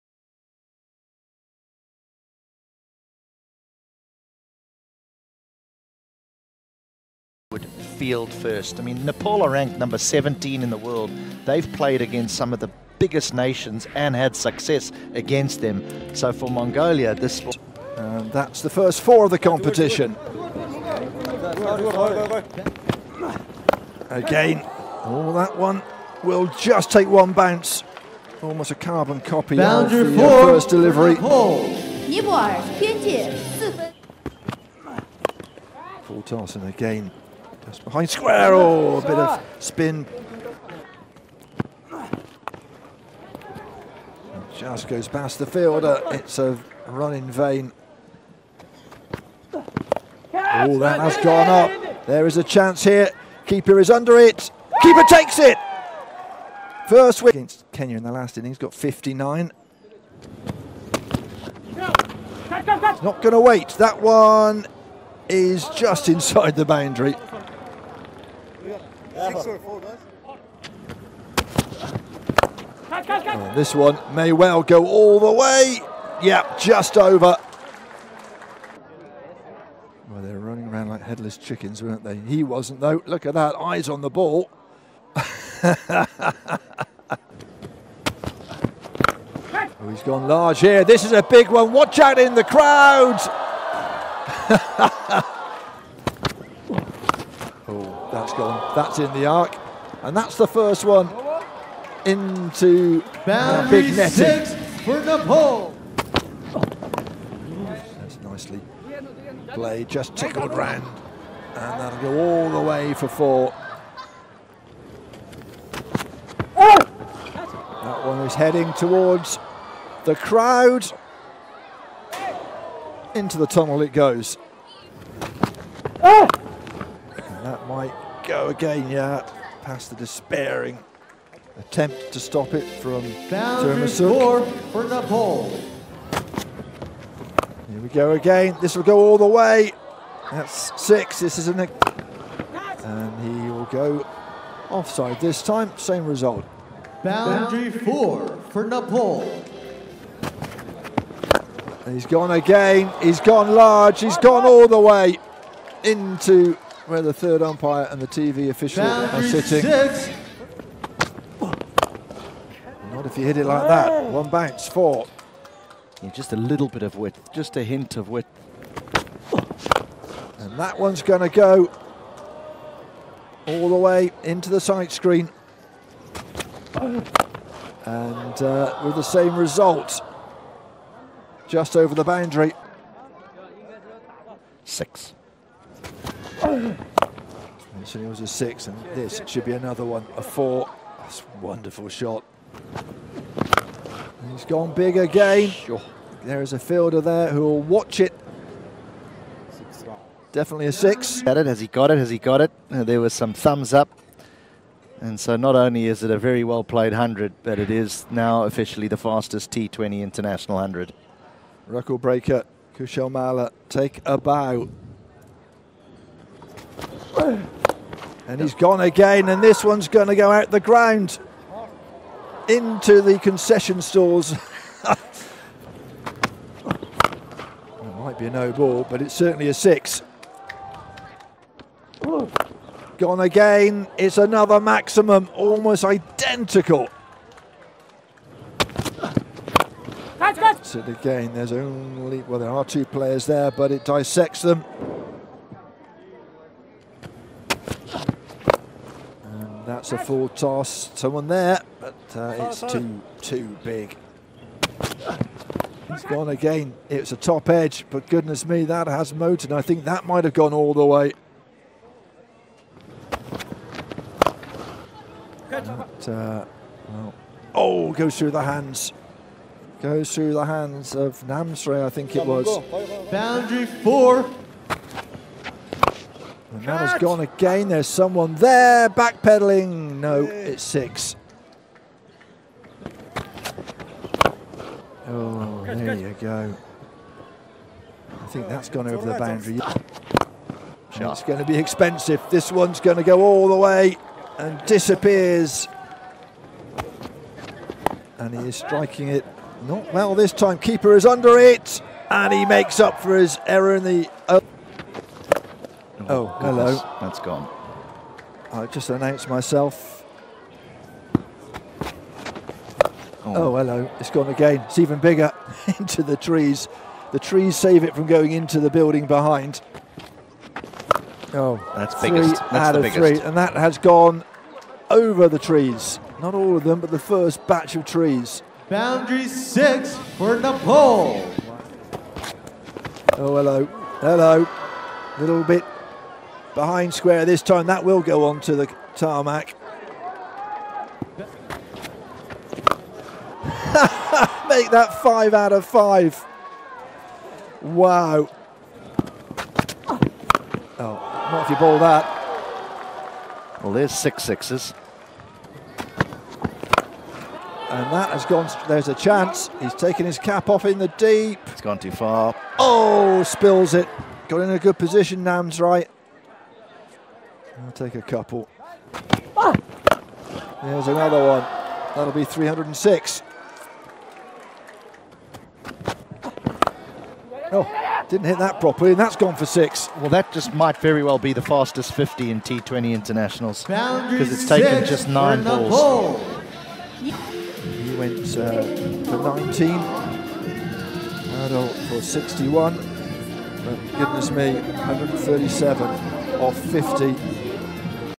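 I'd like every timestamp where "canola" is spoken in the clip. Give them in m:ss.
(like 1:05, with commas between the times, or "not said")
not said.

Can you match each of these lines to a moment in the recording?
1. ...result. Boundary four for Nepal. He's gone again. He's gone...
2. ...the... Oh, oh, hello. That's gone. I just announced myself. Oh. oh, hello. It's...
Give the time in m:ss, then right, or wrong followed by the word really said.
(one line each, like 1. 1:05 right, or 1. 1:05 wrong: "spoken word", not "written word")
1. 2:26 right
2. 5:03 right.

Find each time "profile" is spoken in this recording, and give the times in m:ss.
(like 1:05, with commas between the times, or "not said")
not said.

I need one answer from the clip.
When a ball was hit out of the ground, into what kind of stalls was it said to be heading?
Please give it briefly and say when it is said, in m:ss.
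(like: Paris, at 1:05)
Concession stalls, at 3:43.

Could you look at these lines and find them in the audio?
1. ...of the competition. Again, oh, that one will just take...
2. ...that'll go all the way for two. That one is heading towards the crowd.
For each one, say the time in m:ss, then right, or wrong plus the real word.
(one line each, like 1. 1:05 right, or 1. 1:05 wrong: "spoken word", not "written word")
1. 0:19 right
2. 1:51 wrong: "four", not "two".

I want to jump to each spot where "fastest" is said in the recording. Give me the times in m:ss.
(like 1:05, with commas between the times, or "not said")
3:28, 6:21.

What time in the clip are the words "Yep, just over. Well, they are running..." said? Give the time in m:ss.
1:16.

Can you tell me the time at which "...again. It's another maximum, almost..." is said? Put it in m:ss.
3:53.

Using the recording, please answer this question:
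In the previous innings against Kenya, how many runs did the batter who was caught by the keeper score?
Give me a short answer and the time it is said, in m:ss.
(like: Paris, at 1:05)
59, at 0:58.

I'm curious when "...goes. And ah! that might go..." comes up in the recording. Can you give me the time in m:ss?
2:03.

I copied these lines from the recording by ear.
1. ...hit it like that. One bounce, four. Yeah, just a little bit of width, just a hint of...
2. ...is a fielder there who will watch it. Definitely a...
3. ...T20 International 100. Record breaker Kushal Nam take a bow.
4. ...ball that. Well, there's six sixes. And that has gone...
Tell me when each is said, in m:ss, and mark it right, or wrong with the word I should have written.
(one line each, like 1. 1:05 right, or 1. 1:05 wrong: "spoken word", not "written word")
1. 2:43 right
2. 3:16 right
3. 3:29 wrong: "Malla", not "Nam"
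4. 5:51 right.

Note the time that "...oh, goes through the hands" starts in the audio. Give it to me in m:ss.
4:27.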